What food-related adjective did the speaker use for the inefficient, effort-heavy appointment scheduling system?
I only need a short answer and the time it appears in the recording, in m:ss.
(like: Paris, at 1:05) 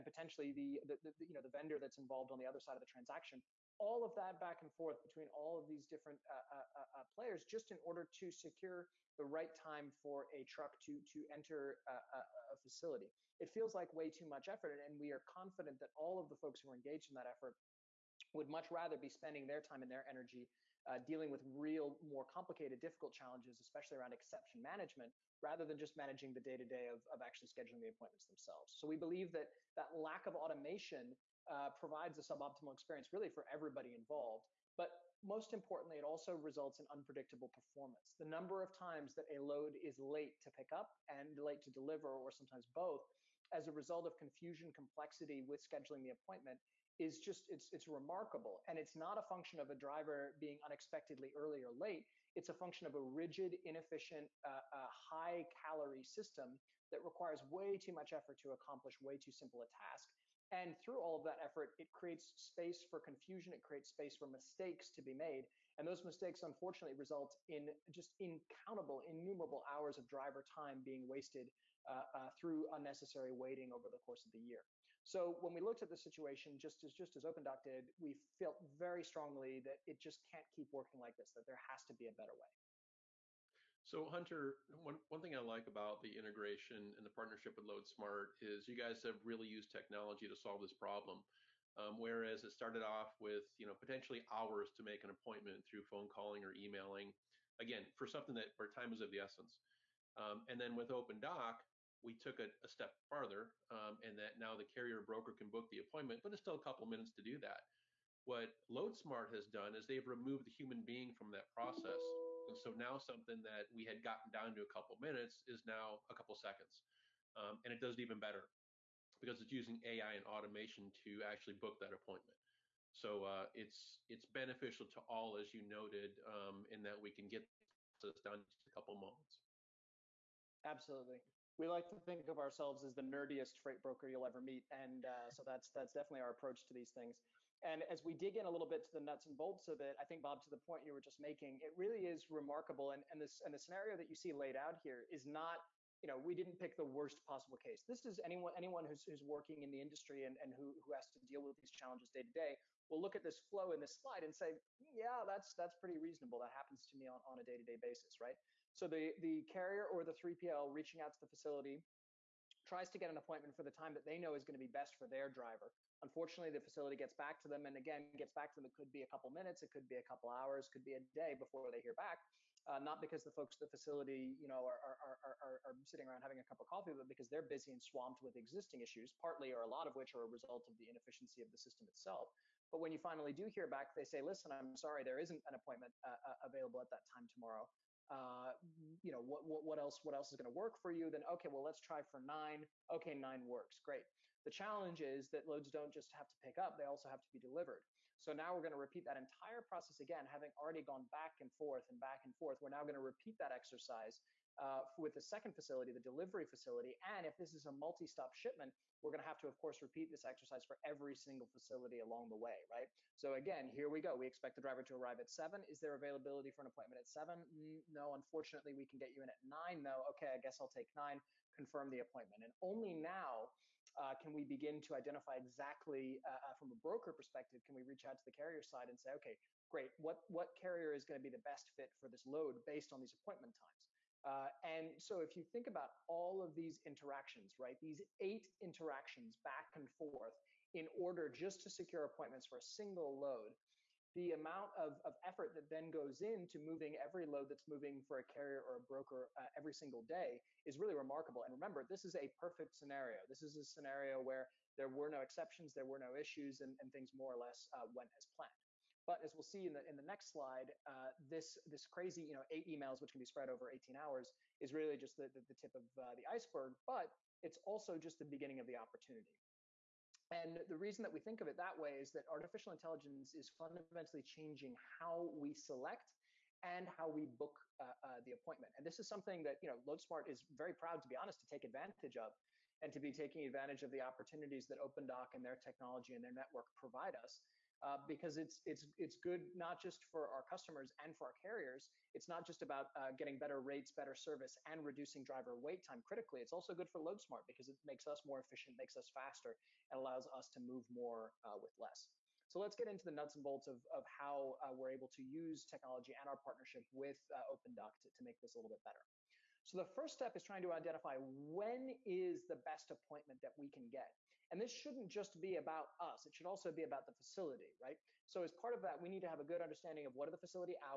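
high calorie, at 0:54.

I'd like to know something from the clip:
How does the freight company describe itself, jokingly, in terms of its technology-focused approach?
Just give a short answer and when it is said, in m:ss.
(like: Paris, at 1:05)
the nerdiest freight broker, at 2:12.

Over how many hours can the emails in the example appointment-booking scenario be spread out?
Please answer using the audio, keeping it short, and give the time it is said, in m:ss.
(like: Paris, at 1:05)
18 hours, at 4:23.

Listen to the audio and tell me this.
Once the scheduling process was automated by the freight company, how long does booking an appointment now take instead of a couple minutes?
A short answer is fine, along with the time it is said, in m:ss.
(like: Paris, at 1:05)
a couple seconds, at 1:56.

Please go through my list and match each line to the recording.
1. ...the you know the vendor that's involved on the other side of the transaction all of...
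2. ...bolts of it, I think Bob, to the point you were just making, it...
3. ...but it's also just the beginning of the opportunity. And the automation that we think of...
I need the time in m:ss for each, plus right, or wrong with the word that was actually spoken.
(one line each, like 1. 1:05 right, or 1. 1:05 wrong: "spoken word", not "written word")
1. 0:01 right
2. 2:19 right
3. 4:26 wrong: "reason", not "automation".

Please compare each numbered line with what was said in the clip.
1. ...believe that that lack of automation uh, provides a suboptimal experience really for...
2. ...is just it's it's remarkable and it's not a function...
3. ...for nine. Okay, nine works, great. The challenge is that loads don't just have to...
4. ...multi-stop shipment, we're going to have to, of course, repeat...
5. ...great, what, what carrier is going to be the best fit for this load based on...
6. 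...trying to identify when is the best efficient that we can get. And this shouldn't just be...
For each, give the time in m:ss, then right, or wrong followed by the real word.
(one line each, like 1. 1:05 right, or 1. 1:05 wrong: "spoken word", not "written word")
1. 0:29 right
2. 0:46 right
3. 3:12 right
4. 3:27 right
5. 3:49 right
6. 5:10 wrong: "appointment", not "efficient".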